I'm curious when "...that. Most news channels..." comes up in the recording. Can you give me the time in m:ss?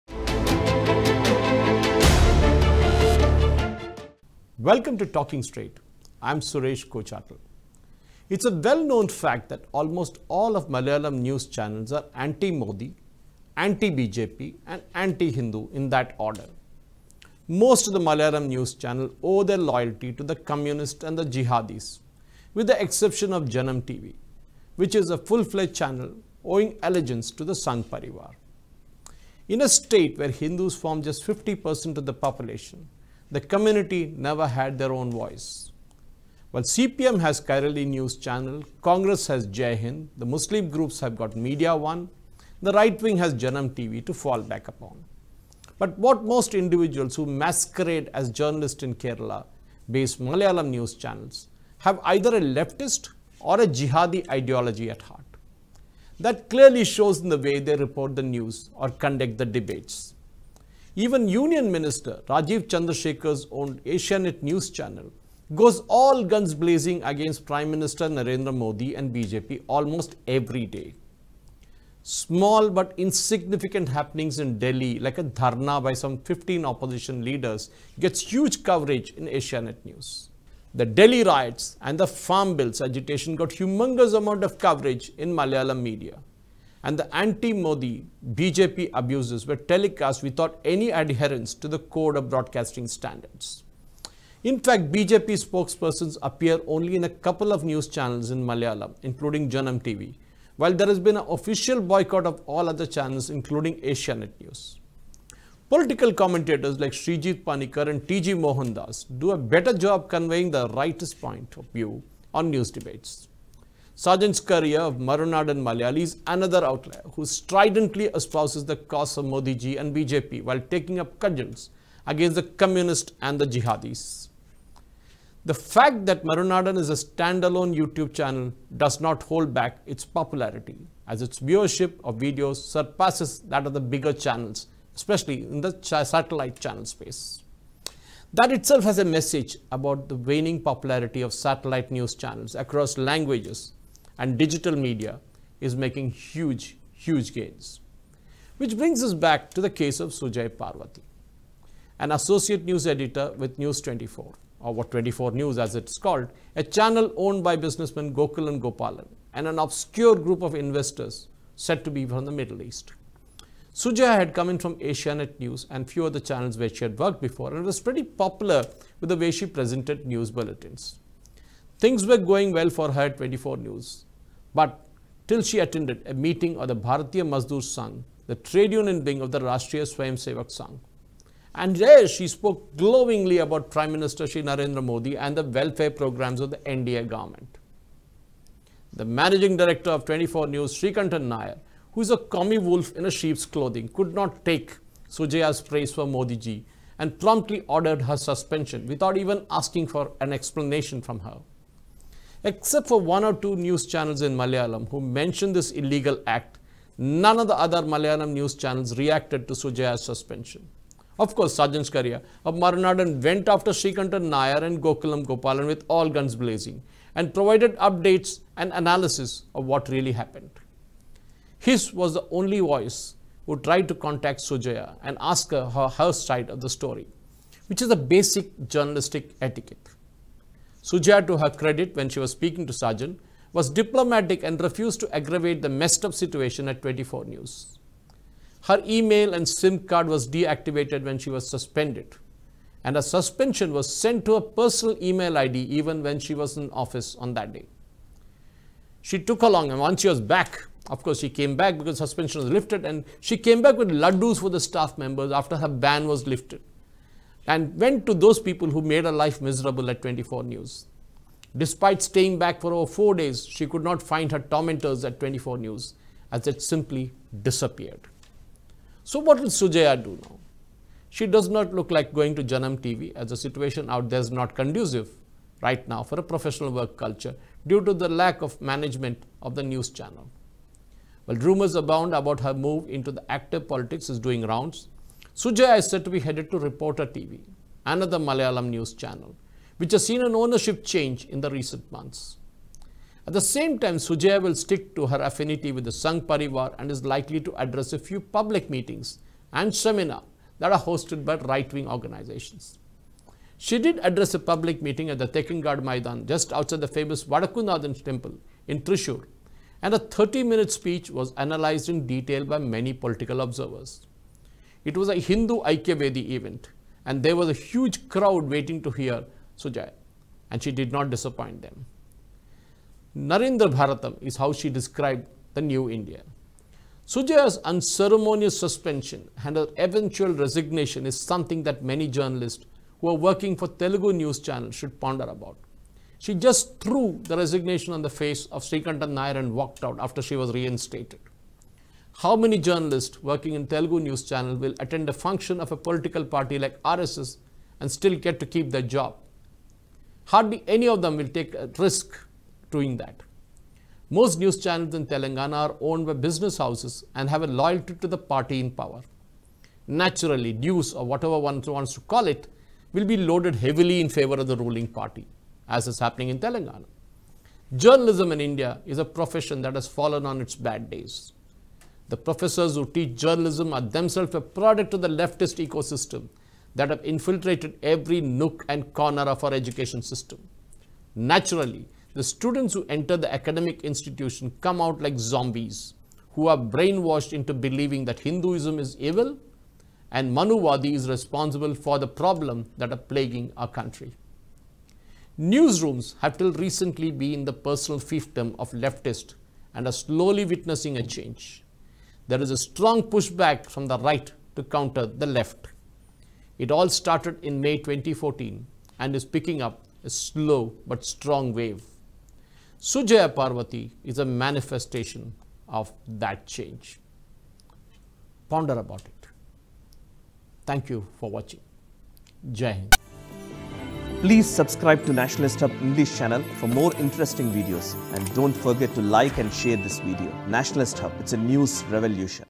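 5:53.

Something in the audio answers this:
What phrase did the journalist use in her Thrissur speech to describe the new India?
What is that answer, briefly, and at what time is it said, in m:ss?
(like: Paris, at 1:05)
Narendra Bharatam, at 5:23.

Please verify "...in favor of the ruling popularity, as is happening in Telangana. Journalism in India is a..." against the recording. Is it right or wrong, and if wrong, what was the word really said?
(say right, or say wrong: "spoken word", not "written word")
wrong: "party", not "popularity".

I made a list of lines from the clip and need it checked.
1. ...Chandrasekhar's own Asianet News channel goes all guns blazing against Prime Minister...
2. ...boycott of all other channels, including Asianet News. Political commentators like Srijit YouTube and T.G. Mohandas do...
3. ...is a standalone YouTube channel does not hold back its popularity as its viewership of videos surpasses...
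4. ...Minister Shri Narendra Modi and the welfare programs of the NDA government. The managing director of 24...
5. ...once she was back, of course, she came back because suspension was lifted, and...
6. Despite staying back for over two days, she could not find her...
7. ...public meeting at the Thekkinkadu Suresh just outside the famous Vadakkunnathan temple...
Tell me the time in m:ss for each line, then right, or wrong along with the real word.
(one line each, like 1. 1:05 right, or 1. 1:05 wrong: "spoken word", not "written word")
1. 1:02 right
2. 1:41 wrong: "Panikar", not "YouTube"
3. 2:06 right
4. 3:03 right
5. 4:09 right
6. 4:21 wrong: "four", not "two"
7. 5:04 wrong: "Maidan", not "Suresh".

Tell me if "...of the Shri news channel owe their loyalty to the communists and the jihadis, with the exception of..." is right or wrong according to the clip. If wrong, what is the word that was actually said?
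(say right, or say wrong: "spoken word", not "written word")
wrong: "Malayalam", not "Shri".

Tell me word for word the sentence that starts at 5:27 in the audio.
Sujaya's unceremonious suspension and her eventual resignation is something that many journalists who are working for Telugu news channels should ponder about.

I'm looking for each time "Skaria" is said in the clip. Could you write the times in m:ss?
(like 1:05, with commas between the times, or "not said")
1:54, 3:31.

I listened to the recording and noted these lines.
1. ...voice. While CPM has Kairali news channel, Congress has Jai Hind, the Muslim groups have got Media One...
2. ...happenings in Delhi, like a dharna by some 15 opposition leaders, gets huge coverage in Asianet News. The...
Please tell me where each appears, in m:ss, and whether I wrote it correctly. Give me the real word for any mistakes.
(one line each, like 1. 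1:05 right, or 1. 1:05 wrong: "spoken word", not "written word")
1. 0:35 right
2. 1:13 right.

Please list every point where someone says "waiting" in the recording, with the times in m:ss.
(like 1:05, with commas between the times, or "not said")
5:18.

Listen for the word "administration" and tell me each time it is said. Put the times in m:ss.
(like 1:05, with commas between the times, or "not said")
not said.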